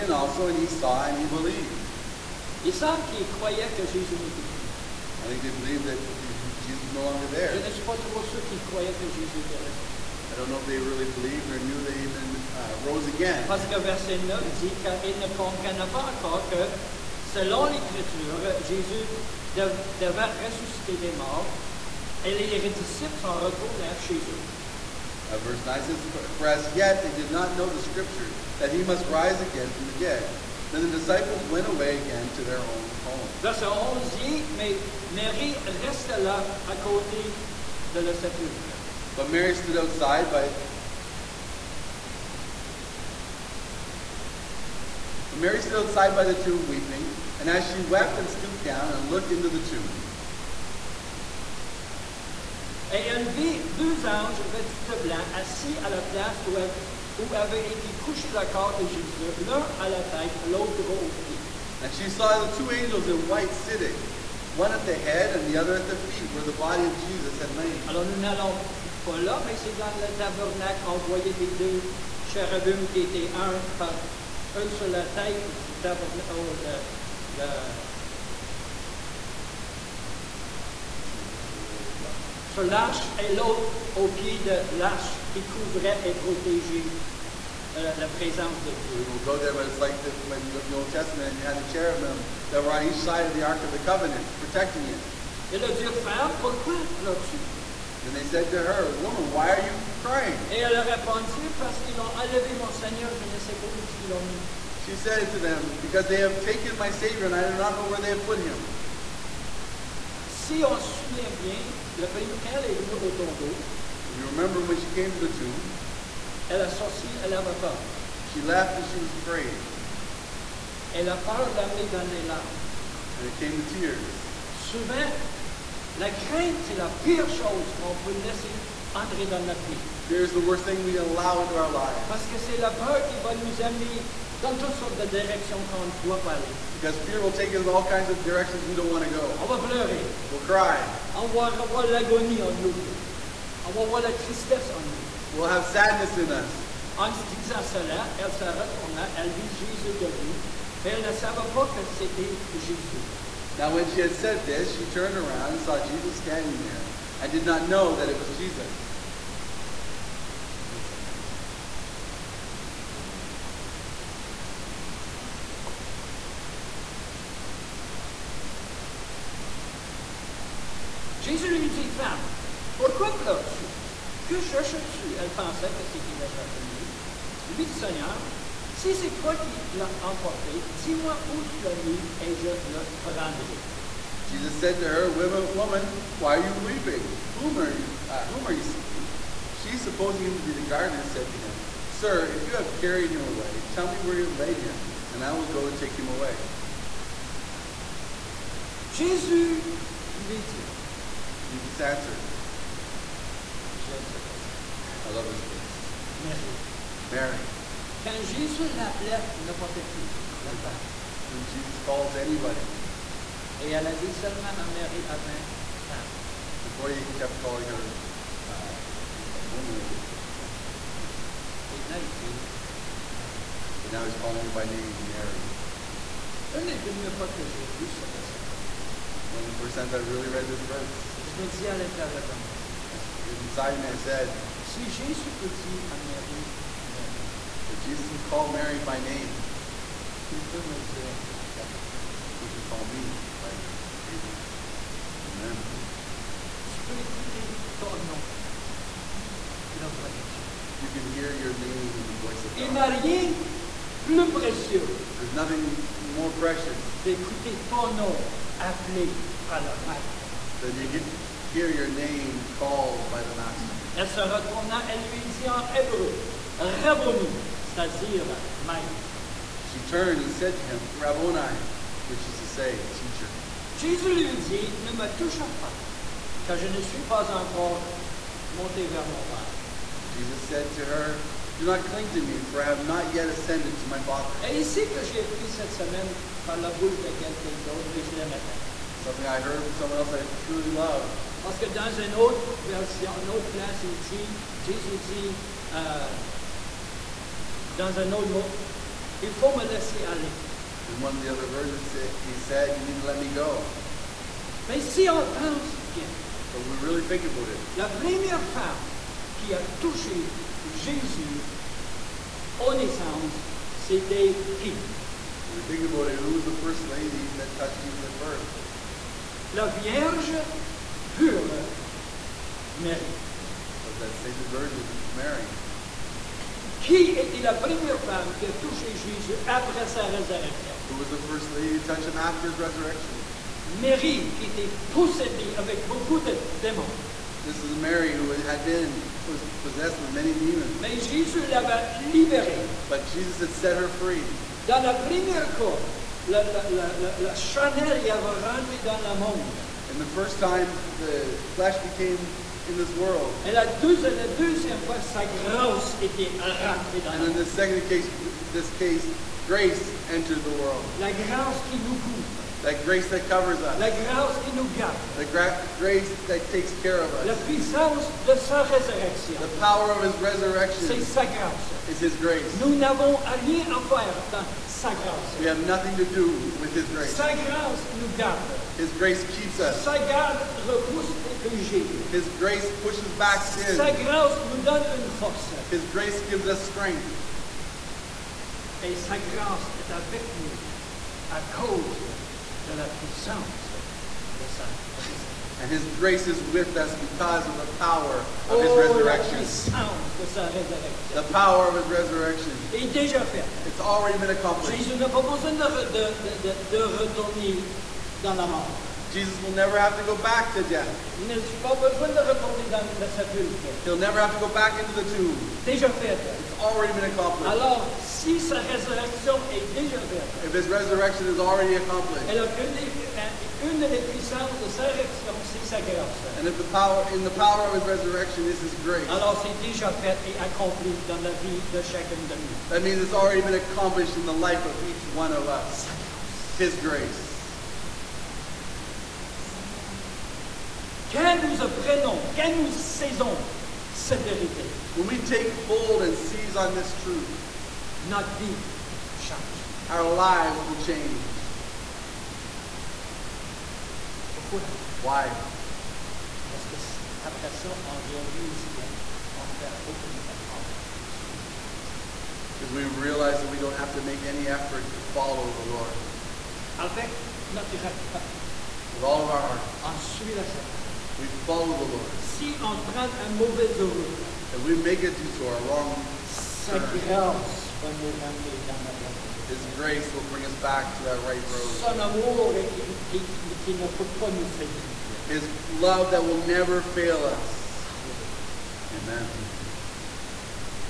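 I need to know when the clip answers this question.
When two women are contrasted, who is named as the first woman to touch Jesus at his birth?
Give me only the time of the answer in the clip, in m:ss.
5:24.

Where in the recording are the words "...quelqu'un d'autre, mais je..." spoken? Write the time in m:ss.
4:47.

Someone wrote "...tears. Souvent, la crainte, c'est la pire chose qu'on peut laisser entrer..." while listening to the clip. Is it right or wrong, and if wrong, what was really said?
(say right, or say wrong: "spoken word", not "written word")
right.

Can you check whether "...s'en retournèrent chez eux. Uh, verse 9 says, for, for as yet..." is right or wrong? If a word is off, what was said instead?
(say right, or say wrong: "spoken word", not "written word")
right.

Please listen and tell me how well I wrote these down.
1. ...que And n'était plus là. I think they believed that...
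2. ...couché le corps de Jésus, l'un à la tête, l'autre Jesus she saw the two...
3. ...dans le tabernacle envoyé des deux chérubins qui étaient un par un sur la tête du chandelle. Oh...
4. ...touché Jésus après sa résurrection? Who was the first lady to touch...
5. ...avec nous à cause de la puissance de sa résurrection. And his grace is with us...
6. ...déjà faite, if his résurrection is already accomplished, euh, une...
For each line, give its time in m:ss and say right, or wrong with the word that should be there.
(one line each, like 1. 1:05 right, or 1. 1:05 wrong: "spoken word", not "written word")
1. 0:03 wrong: "Jésus", not "And"
2. 0:57 wrong: "And", not "Jesus"
3. 1:09 wrong: "tabernacle", not "chandelle"
4. 5:28 right
5. 6:29 right
6. 6:59 wrong: "resurrection", not "résurrection".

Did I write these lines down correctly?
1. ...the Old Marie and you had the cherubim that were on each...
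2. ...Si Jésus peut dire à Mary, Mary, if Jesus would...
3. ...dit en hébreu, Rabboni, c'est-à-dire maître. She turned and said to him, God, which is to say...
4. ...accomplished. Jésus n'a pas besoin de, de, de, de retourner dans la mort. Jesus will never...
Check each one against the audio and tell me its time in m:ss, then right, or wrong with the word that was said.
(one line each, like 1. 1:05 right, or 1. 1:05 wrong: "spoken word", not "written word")
1. 1:30 wrong: "Testament", not "Marie"
2. 3:54 right
3. 4:25 wrong: "Rabboni", not "God"
4. 6:44 right.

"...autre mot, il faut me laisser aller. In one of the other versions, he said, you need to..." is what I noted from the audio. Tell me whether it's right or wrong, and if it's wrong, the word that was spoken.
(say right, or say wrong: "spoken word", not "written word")
right.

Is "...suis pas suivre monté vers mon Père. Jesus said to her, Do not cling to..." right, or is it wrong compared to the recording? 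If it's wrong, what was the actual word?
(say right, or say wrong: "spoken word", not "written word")
wrong: "encore", not "suivre".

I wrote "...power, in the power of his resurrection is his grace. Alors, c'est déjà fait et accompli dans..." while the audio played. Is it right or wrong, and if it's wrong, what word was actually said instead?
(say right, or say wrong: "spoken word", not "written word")
right.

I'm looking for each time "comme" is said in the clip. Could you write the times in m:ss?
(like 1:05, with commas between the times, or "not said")
3:48.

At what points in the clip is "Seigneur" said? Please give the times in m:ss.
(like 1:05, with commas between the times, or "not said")
1:42, 2:57, 7:41, 7:50.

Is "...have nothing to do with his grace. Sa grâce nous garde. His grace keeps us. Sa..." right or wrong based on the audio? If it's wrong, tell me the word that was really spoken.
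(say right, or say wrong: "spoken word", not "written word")
right.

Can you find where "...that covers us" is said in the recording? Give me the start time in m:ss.
6:03.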